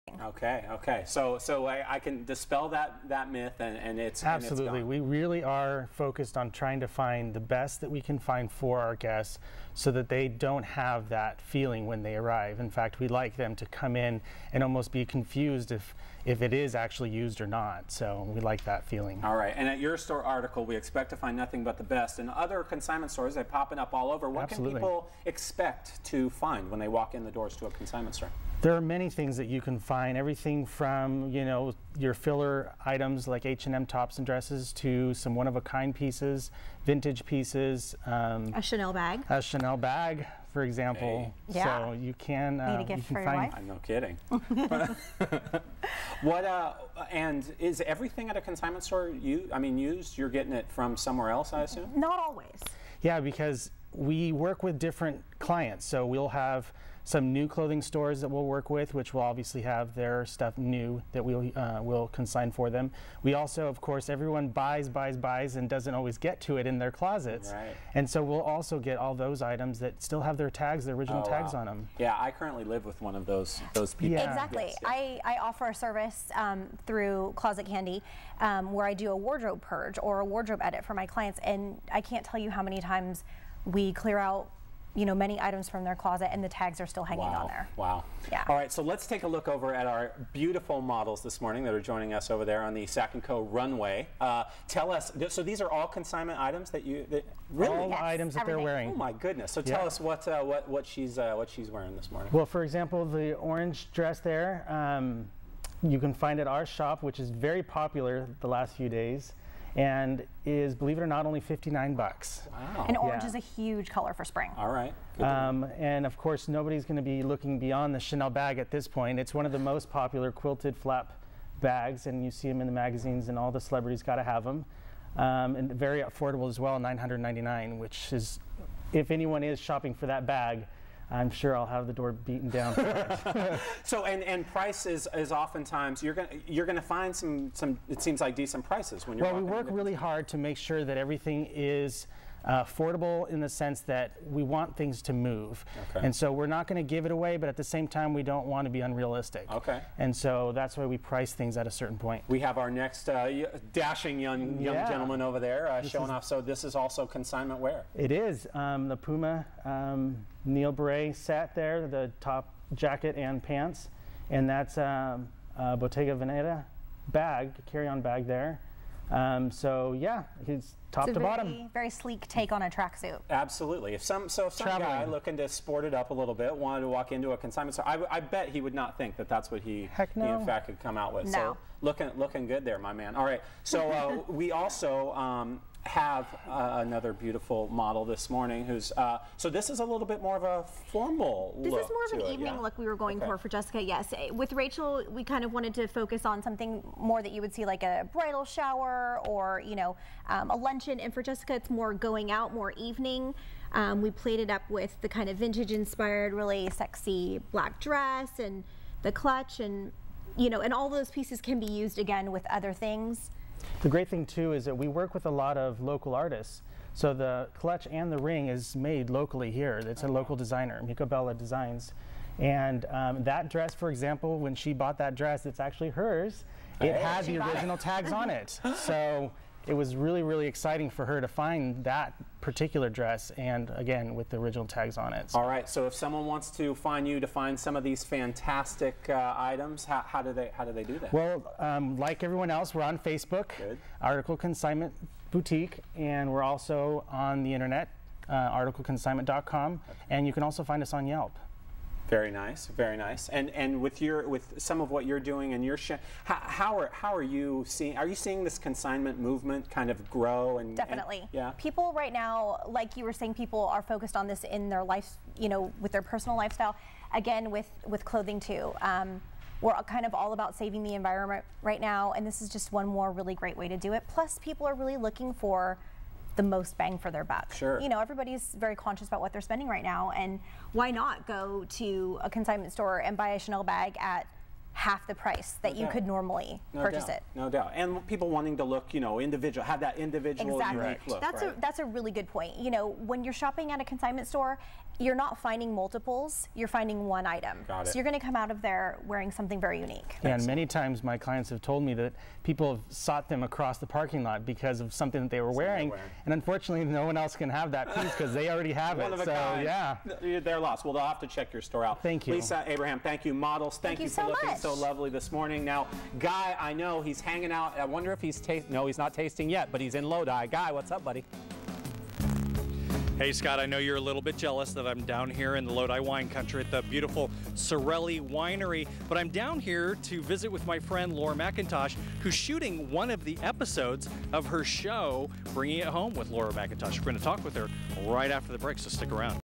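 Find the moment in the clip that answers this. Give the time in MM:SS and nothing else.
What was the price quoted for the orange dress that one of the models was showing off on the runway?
01:51.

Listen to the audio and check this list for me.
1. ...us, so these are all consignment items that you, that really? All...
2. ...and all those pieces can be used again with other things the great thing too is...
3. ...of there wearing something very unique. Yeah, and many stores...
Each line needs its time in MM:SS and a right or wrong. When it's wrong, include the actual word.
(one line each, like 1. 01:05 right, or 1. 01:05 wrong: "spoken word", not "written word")
1. 01:34 right
2. 03:30 right
3. 04:58 wrong: "times", not "stores".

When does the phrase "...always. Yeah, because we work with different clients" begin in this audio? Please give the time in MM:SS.
00:52.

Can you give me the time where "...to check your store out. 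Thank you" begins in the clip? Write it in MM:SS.
05:11.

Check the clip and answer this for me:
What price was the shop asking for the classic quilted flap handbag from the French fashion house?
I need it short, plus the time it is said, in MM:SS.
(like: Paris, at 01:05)
999, at 02:06.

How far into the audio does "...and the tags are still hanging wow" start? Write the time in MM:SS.
01:26.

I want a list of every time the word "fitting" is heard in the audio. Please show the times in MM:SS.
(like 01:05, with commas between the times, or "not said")
not said.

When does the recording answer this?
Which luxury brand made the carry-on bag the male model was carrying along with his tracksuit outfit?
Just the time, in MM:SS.
02:45.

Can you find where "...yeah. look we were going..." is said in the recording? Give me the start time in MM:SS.
03:12.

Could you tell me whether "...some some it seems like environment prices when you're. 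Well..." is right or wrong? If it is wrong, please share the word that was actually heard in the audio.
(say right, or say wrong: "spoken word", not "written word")
wrong: "decent", not "environment".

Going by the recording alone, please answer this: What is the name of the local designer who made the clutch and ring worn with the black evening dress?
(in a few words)
Bella Designs.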